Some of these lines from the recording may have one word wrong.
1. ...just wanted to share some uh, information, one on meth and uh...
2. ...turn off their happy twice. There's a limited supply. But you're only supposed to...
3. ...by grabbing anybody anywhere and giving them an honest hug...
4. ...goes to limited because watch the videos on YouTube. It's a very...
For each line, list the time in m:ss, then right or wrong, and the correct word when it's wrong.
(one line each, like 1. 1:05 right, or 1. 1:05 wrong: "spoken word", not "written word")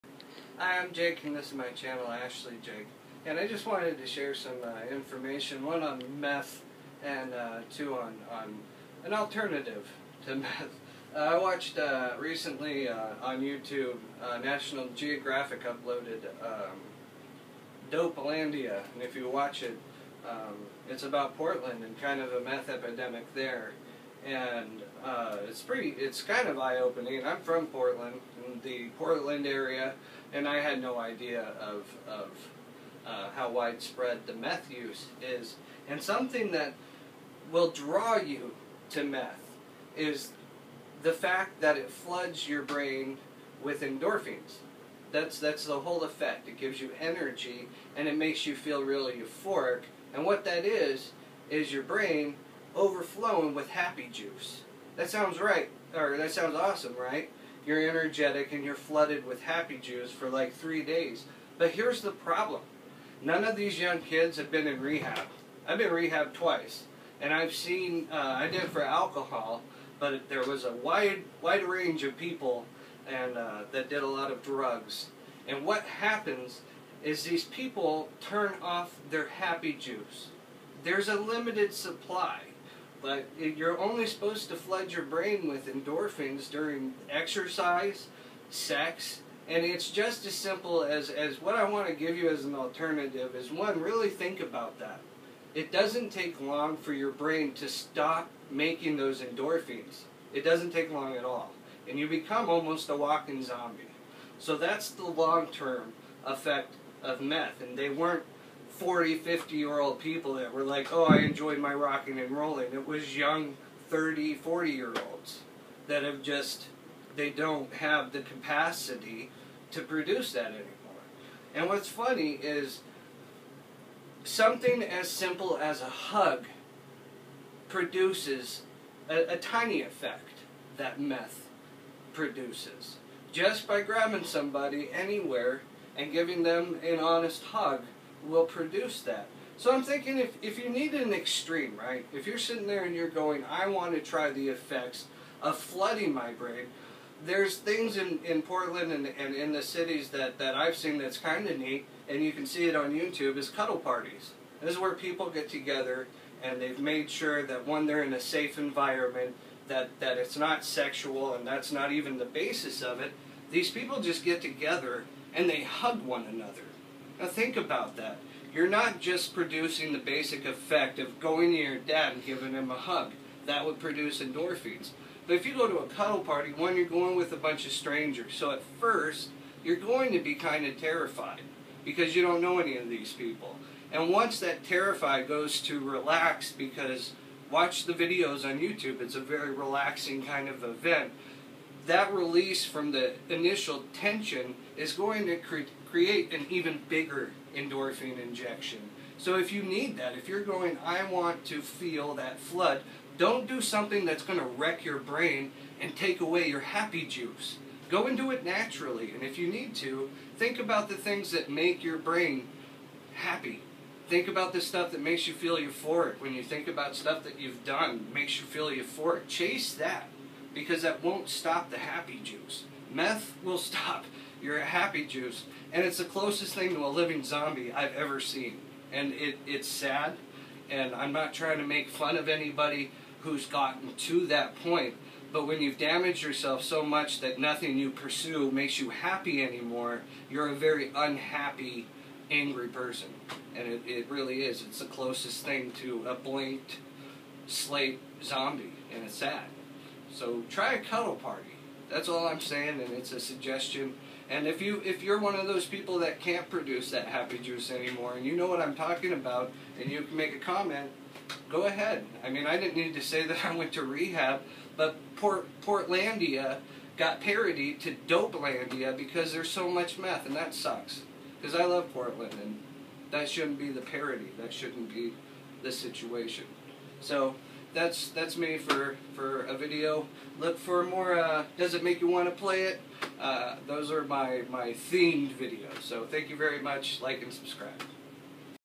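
1. 0:03 right
2. 1:18 wrong: "juice", not "twice"
3. 2:13 wrong: "somebody", not "anybody"
4. 3:05 wrong: "relaxed", not "limited".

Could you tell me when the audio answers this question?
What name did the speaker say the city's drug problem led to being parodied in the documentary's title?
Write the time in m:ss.
4:25.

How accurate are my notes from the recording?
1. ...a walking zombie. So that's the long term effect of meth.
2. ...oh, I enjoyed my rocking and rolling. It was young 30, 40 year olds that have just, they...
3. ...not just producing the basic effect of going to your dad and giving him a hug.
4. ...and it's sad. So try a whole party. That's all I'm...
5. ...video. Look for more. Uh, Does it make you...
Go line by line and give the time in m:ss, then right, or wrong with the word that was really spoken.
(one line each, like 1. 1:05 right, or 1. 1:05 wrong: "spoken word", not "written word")
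1. 1:42 right
2. 1:50 right
3. 2:48 right
4. 4:08 wrong: "cuddle", not "whole"
5. 4:39 right.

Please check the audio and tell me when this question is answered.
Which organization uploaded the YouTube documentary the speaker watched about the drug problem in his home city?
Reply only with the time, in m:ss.
0:14.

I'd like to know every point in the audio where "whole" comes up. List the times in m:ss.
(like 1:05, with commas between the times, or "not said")
0:45.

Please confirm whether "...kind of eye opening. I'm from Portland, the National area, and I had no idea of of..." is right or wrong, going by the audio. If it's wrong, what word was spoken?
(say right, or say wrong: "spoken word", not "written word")
wrong: "Portland", not "National".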